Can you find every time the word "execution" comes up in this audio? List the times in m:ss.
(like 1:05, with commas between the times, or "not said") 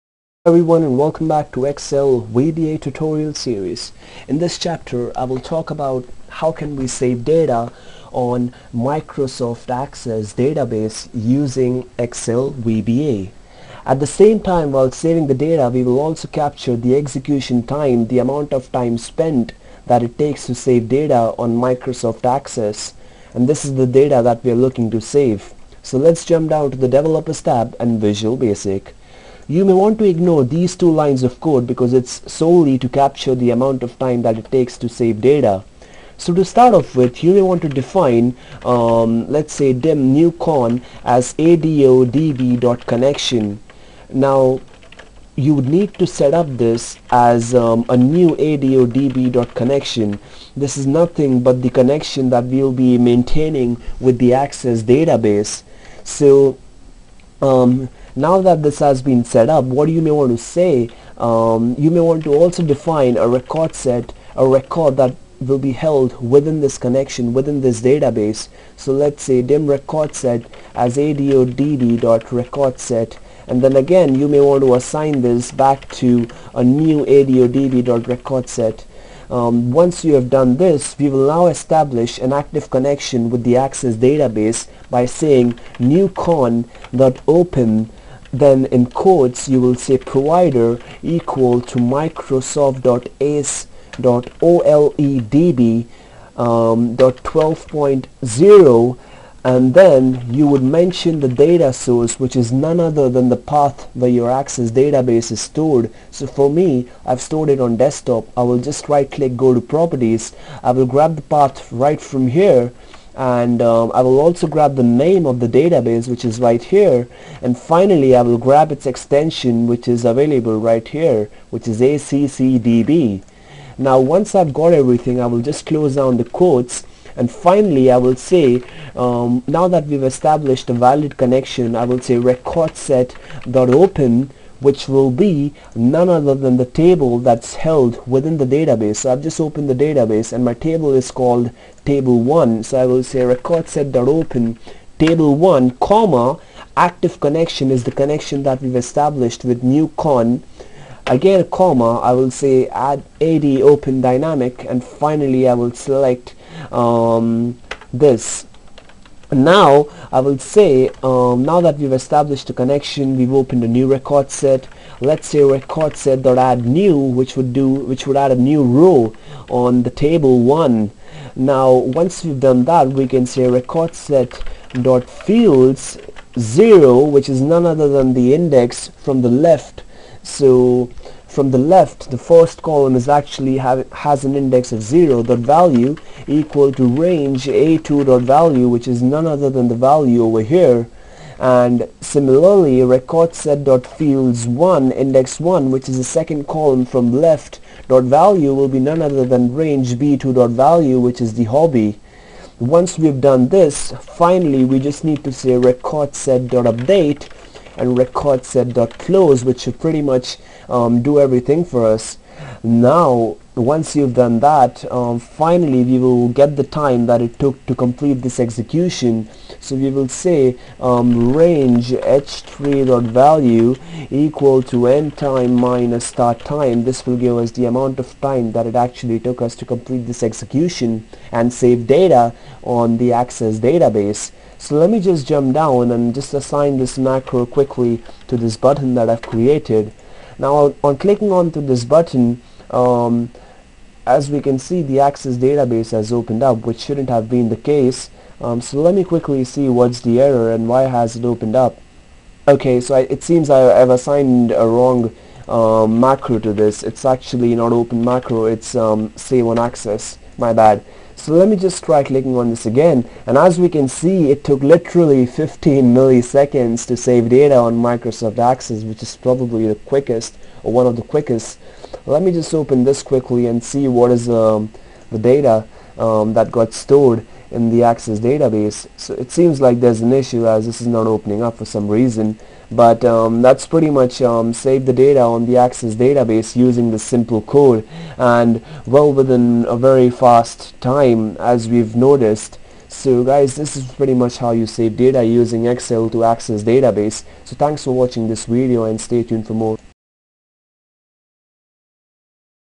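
0:16, 3:38, 3:50.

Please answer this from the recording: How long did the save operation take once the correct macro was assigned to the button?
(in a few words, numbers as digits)
15 milliseconds.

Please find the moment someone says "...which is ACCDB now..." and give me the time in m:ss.
2:01.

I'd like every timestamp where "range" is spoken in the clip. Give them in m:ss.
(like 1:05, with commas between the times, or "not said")
3:06, 3:19, 3:41.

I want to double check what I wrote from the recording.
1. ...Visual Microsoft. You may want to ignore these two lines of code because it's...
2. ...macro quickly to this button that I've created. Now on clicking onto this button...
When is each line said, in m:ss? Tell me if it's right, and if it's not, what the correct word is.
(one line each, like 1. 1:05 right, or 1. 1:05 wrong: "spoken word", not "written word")
1. 0:28 wrong: "Basic", not "Microsoft"
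2. 3:56 right.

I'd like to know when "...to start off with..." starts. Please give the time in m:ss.
0:36.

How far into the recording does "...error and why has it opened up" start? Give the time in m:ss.
4:10.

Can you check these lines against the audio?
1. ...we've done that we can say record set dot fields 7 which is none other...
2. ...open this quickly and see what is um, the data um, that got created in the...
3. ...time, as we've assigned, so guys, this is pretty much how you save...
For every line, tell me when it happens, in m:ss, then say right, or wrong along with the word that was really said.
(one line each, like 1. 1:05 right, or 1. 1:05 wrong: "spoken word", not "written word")
1. 2:52 wrong: "0", not "7"
2. 4:32 wrong: "stored", not "created"
3. 4:50 wrong: "noticed", not "assigned".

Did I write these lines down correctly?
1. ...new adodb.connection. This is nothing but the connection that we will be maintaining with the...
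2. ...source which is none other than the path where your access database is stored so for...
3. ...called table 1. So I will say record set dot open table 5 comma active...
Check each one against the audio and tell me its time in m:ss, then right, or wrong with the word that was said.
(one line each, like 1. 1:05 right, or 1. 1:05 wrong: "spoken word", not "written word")
1. 0:47 right
2. 1:41 right
3. 2:21 wrong: "1", not "5".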